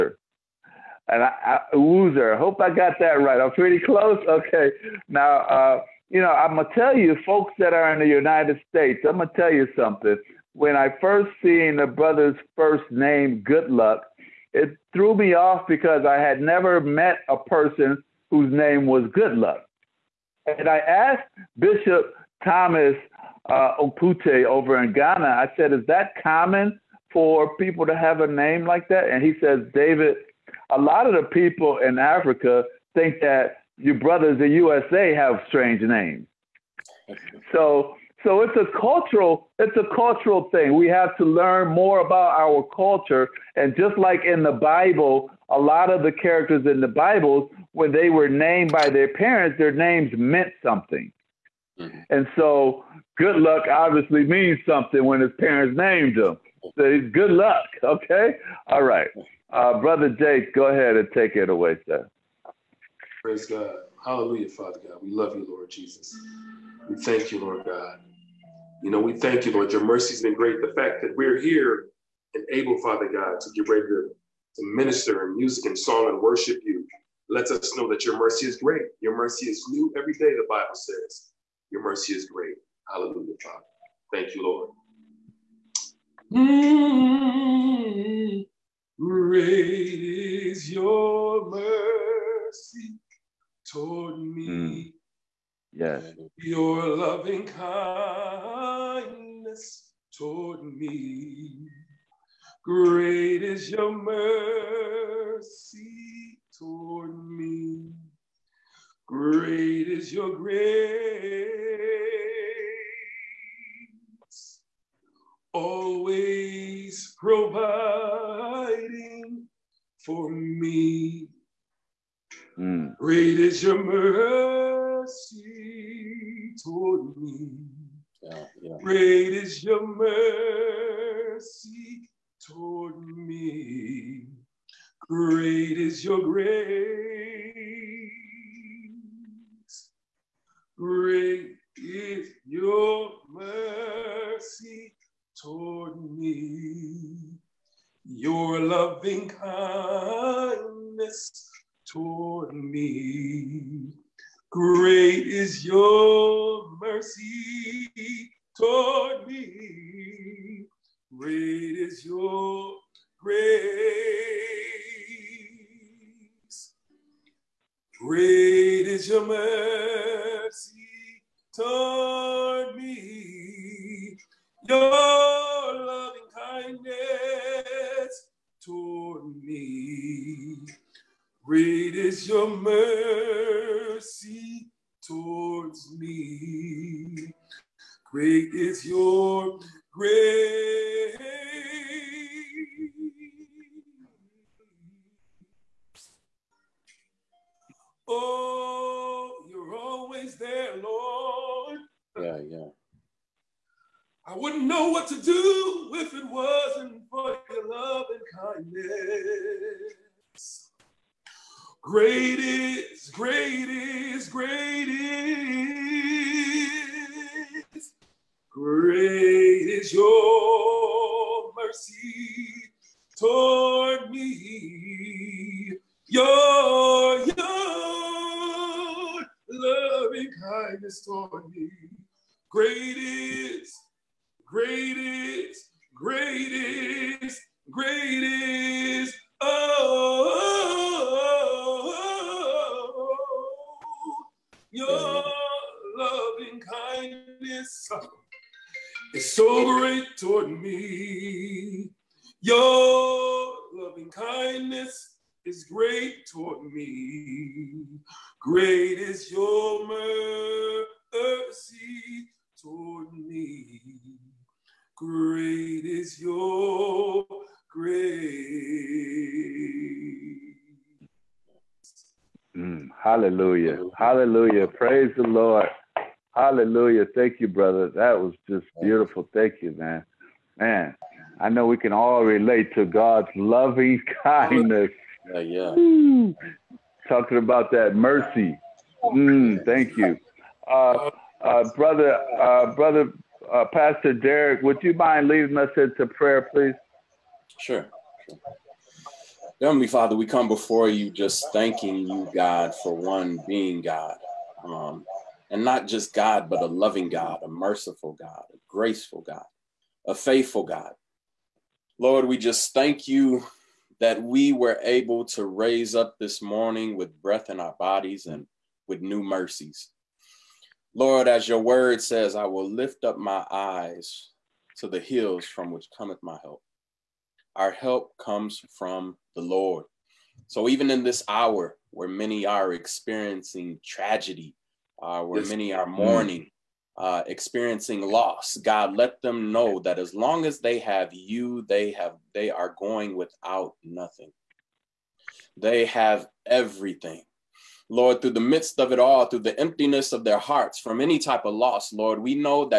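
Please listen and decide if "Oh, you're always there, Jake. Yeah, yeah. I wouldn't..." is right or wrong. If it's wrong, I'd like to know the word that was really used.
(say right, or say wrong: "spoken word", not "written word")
wrong: "Lord", not "Jake".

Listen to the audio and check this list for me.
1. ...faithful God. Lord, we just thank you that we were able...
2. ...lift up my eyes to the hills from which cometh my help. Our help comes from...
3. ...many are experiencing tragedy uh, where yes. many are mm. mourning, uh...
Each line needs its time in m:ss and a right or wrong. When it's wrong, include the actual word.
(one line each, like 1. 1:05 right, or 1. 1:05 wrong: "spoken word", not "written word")
1. 5:10 right
2. 5:22 right
3. 5:32 right.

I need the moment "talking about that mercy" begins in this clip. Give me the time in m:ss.
4:47.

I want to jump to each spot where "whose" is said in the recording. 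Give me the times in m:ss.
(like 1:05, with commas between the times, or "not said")
0:18.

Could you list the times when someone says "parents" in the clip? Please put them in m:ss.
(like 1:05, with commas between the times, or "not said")
0:49, 0:55.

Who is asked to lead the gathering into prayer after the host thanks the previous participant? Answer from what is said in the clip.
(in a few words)
Pastor Derek.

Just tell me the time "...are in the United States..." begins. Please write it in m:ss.
0:07.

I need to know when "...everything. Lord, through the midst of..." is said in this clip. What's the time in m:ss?
5:46.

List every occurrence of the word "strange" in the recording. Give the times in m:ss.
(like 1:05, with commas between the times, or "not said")
0:35.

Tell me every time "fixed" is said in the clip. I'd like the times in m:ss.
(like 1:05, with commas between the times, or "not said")
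not said.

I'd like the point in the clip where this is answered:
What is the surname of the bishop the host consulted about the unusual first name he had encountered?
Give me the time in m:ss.
0:23.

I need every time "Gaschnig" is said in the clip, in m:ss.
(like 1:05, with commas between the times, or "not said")
not said.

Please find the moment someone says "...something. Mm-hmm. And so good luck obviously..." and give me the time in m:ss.
0:50.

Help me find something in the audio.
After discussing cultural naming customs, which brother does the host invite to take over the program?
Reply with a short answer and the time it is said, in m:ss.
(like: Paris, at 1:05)
Jake, at 1:00.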